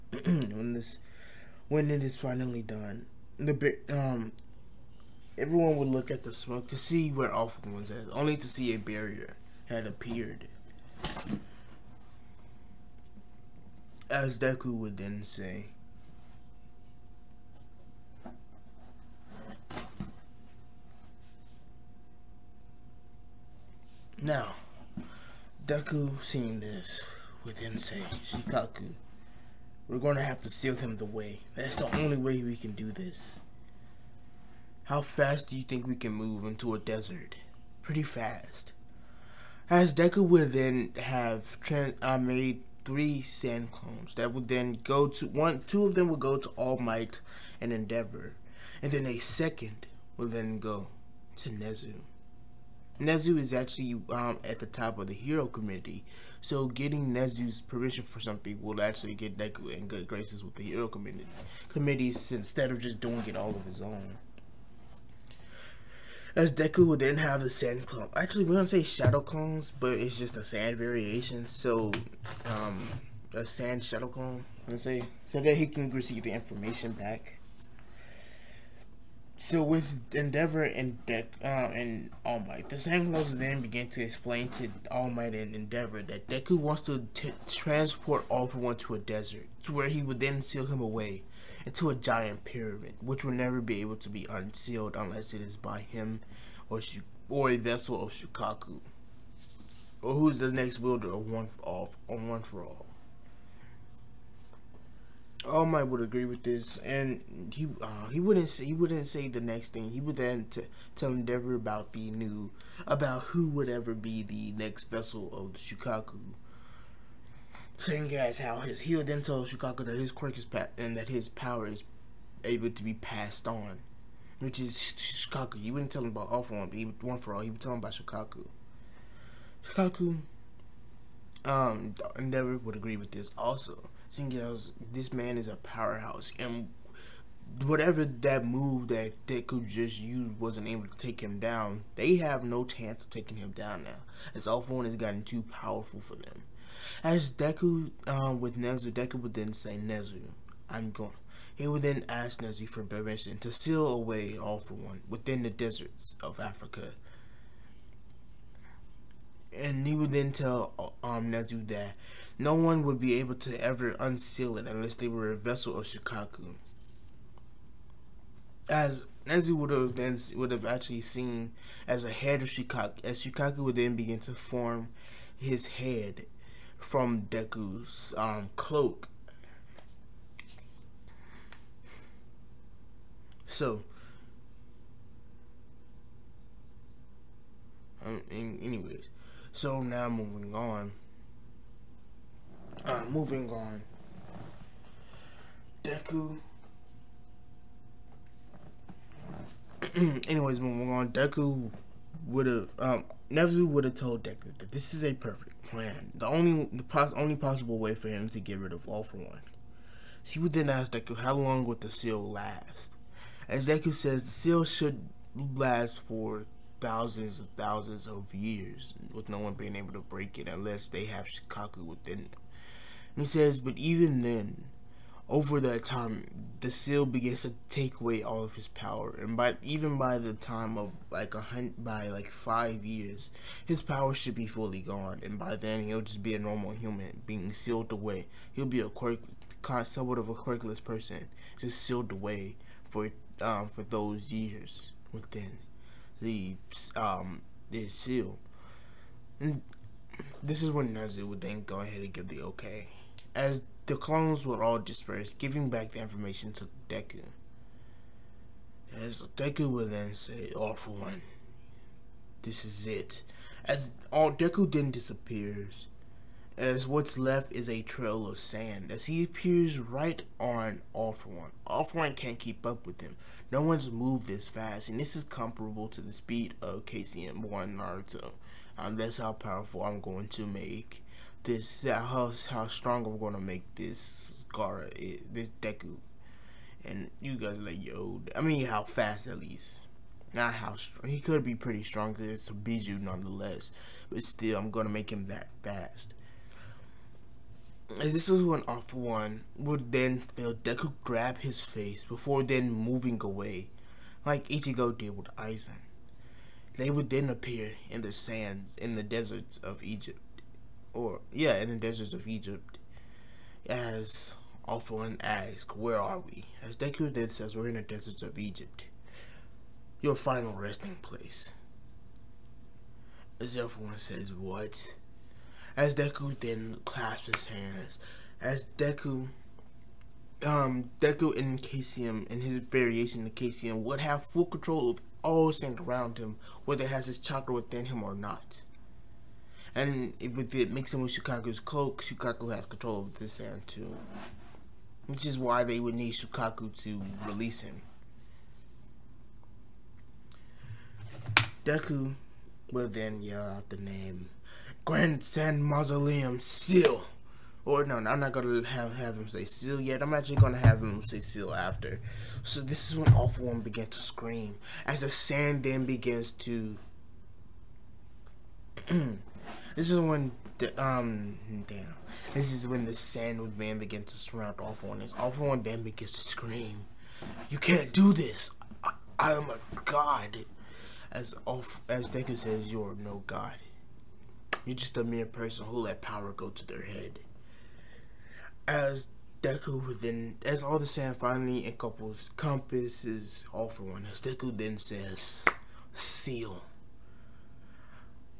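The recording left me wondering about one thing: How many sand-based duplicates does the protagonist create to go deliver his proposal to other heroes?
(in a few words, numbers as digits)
3.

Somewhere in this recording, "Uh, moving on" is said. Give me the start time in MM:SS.
03:12.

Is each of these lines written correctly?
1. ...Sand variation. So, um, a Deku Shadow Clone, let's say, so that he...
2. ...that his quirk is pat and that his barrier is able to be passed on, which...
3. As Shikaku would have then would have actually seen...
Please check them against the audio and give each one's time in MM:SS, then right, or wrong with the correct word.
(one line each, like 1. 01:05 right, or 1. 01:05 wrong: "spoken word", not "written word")
1. 01:10 wrong: "Sand", not "Deku"
2. 01:59 wrong: "power", not "barrier"
3. 02:48 wrong: "Nezu", not "Shikaku".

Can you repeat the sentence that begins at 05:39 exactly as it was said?
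And with it mixing with Shukaku's cloak, Shukaku has control of this sand too.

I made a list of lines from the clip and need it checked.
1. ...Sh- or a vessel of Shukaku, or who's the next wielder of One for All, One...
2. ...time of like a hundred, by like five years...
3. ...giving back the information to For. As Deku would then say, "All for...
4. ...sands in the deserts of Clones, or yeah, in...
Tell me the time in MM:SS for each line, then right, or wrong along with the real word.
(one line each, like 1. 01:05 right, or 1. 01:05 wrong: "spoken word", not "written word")
1. 01:36 right
2. 03:50 right
3. 04:15 wrong: "Deku", not "For"
4. 05:08 wrong: "Egypt", not "Clones".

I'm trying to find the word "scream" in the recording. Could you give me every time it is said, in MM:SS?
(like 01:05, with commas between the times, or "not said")
06:04, 06:16.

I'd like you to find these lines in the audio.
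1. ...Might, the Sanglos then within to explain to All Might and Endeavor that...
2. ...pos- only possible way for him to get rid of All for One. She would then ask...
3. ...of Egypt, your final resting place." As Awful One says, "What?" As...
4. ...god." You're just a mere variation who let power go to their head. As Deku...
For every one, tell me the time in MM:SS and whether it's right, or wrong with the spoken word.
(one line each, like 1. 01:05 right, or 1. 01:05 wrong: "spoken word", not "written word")
1. 01:22 wrong: "begin", not "within"
2. 03:26 right
3. 05:18 right
4. 06:23 wrong: "person", not "variation".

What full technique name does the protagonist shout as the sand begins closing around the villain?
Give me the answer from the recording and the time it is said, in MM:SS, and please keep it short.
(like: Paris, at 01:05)
Grand Sand Mausoleum, at 05:54.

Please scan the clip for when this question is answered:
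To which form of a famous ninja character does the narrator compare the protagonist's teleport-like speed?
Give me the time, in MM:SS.
04:36.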